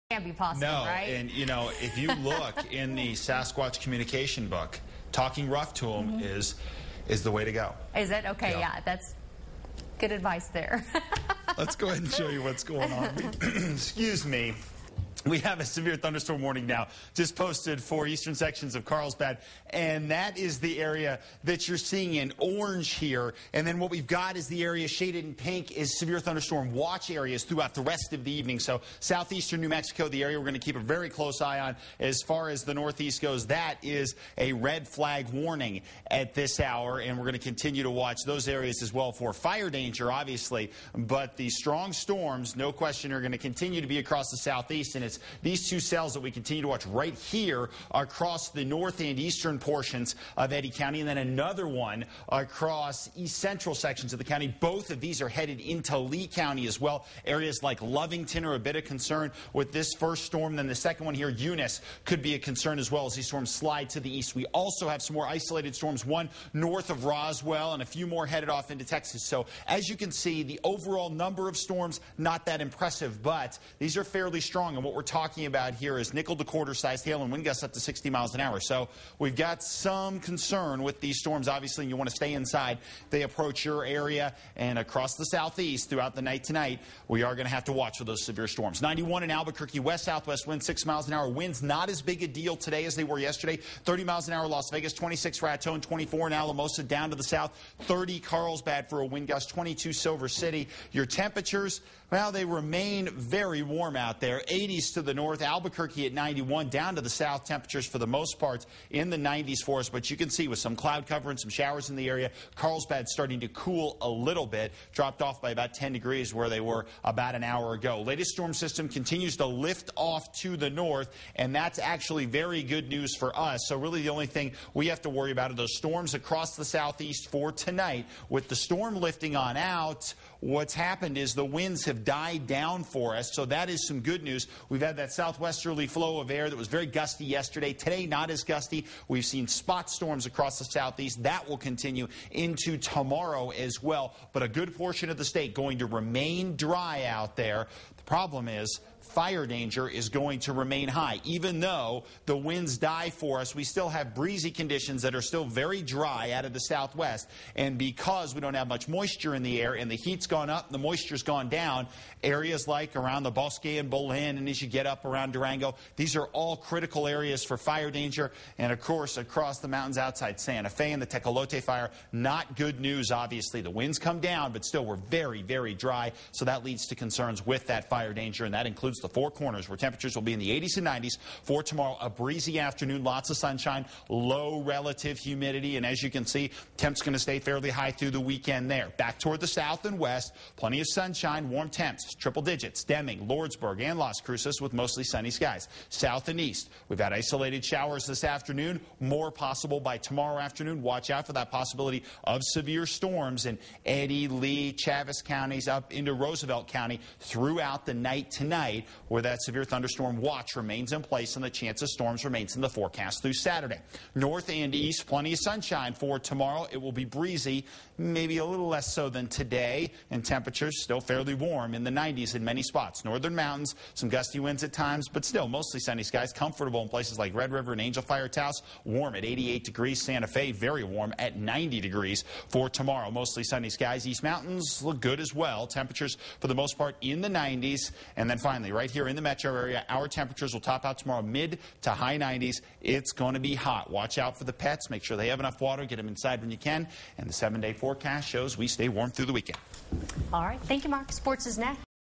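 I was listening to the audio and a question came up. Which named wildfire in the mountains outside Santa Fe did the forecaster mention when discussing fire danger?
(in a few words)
Tecolote fire.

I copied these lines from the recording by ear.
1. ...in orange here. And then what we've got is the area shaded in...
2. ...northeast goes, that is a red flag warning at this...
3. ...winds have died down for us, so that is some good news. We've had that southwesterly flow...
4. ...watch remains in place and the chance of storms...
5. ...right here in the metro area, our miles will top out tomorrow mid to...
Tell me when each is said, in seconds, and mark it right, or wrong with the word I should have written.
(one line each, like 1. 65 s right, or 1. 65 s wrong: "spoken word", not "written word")
1. 22 s right
2. 32 s right
3. 131 s right
4. 210 s right
5. 238 s wrong: "temperatures", not "miles".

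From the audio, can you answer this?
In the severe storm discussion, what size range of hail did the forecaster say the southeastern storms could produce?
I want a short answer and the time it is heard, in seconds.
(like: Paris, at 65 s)
nickel to quarter sized, at 76 s.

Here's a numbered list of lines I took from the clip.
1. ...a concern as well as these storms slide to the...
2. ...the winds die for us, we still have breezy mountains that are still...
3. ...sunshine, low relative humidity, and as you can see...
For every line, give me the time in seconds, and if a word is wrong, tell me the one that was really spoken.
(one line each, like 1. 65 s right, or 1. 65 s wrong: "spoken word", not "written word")
1. 62 s right
2. 152 s wrong: "conditions", not "mountains"
3. 183 s right.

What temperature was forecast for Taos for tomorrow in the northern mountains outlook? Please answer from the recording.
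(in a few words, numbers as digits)
88 degrees.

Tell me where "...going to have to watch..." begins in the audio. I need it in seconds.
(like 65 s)
87 s.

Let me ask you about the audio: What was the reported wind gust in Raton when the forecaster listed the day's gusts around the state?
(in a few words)
26.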